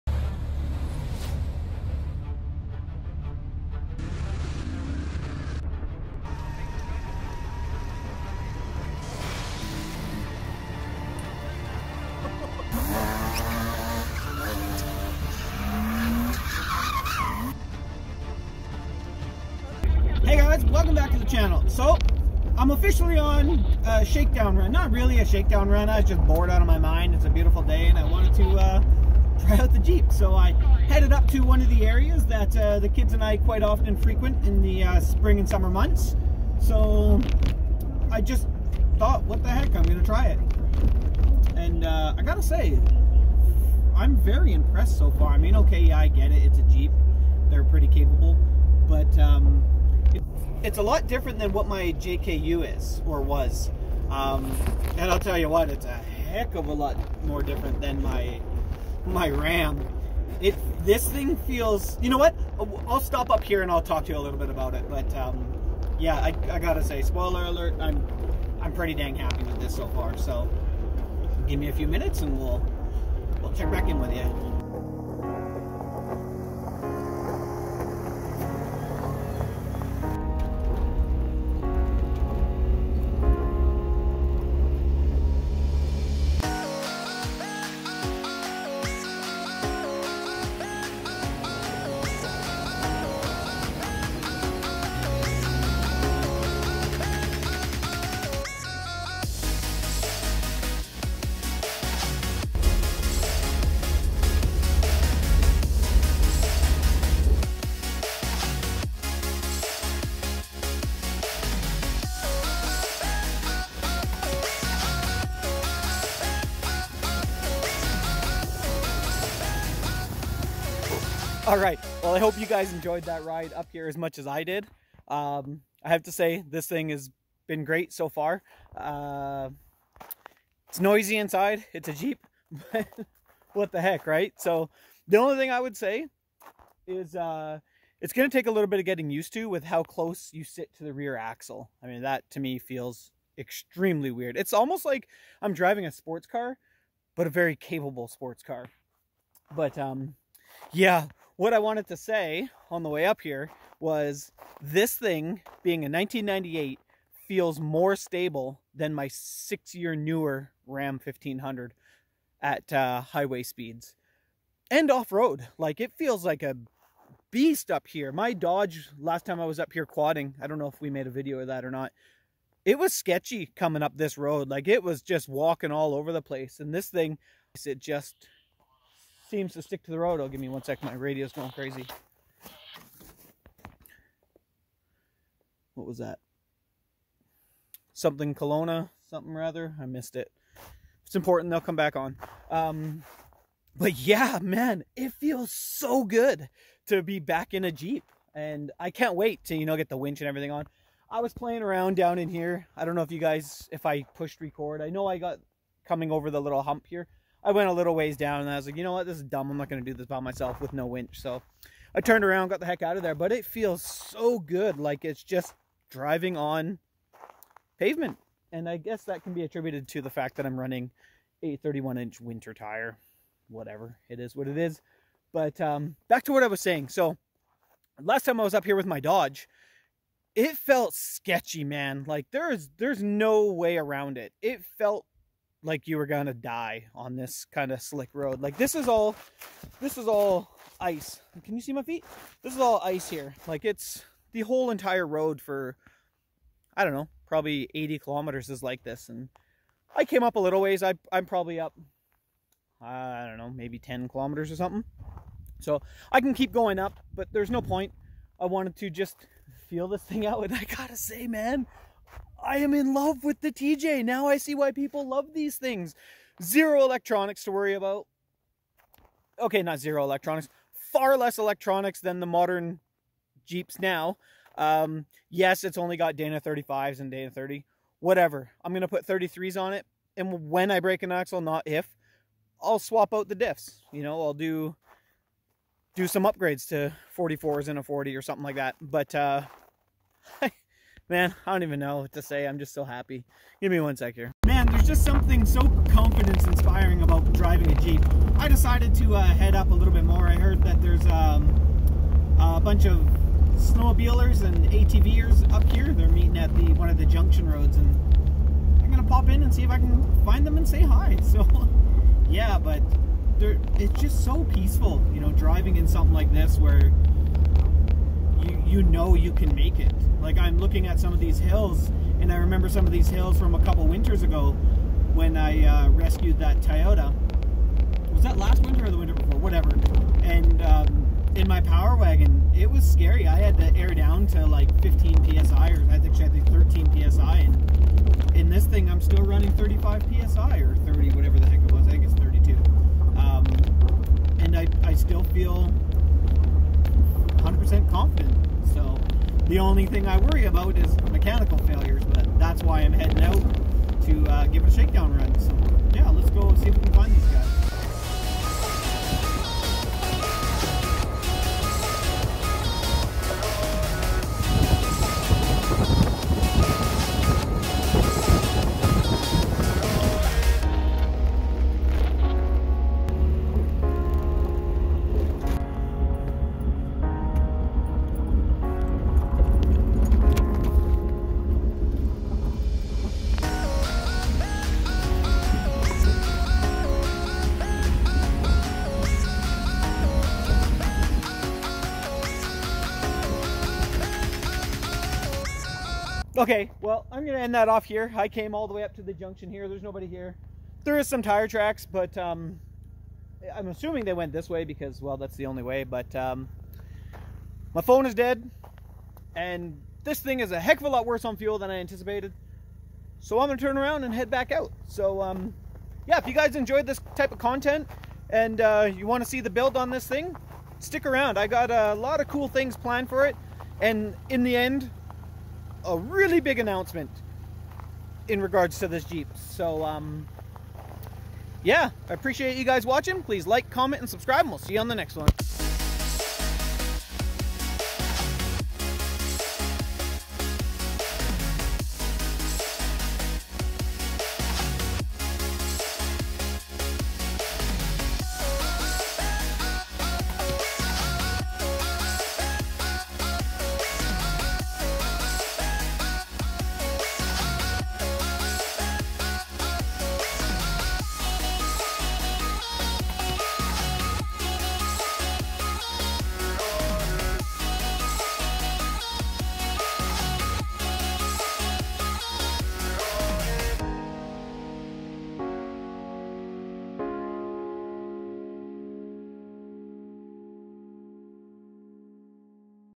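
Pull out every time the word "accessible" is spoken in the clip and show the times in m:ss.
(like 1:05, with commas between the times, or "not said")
not said.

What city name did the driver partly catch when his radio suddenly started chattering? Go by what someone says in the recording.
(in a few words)
Kelowna.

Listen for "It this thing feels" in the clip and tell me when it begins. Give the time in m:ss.
1:00.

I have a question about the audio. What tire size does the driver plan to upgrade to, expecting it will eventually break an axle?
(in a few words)
33s.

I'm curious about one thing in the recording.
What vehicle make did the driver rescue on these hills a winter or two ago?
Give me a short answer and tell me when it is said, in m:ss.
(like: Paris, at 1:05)
Toyota, at 5:26.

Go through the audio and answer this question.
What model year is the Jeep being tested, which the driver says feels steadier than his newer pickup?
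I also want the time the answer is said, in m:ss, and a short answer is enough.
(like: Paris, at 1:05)
1998, at 2:35.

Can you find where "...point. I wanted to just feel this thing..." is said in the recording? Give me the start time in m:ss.
4:17.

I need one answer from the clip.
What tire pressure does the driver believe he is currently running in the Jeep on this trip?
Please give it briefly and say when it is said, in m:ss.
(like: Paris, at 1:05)
32 psi, at 5:42.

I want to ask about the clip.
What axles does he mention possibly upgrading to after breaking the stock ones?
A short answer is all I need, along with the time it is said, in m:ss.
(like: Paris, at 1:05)
44s, at 4:47.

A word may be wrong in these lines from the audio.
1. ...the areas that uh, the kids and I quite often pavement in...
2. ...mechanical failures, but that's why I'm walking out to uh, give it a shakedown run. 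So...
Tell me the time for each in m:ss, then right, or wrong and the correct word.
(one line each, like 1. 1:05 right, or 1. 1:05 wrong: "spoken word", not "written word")
1. 0:31 wrong: "frequent", not "pavement"
2. 5:51 wrong: "heading", not "walking".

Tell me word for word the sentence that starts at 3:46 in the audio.
So last time I was up here with my Dodge, it felt sketchy, man.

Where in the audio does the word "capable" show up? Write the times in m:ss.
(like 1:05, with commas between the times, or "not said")
0:47, 2:27.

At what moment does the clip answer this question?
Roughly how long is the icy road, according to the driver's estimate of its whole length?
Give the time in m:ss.
4:07.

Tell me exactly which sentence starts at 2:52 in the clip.
It was sketchy coming up this road.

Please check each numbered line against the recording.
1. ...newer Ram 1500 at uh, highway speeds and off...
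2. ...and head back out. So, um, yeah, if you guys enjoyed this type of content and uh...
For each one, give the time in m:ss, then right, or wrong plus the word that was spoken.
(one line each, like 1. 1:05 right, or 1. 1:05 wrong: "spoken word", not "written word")
1. 2:39 right
2. 6:54 right.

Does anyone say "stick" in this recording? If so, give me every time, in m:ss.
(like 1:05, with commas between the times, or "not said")
2:59, 7:00.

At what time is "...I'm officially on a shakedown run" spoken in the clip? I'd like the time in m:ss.
0:22.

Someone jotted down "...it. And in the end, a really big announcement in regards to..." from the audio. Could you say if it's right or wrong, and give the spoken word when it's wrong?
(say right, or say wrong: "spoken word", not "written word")
right.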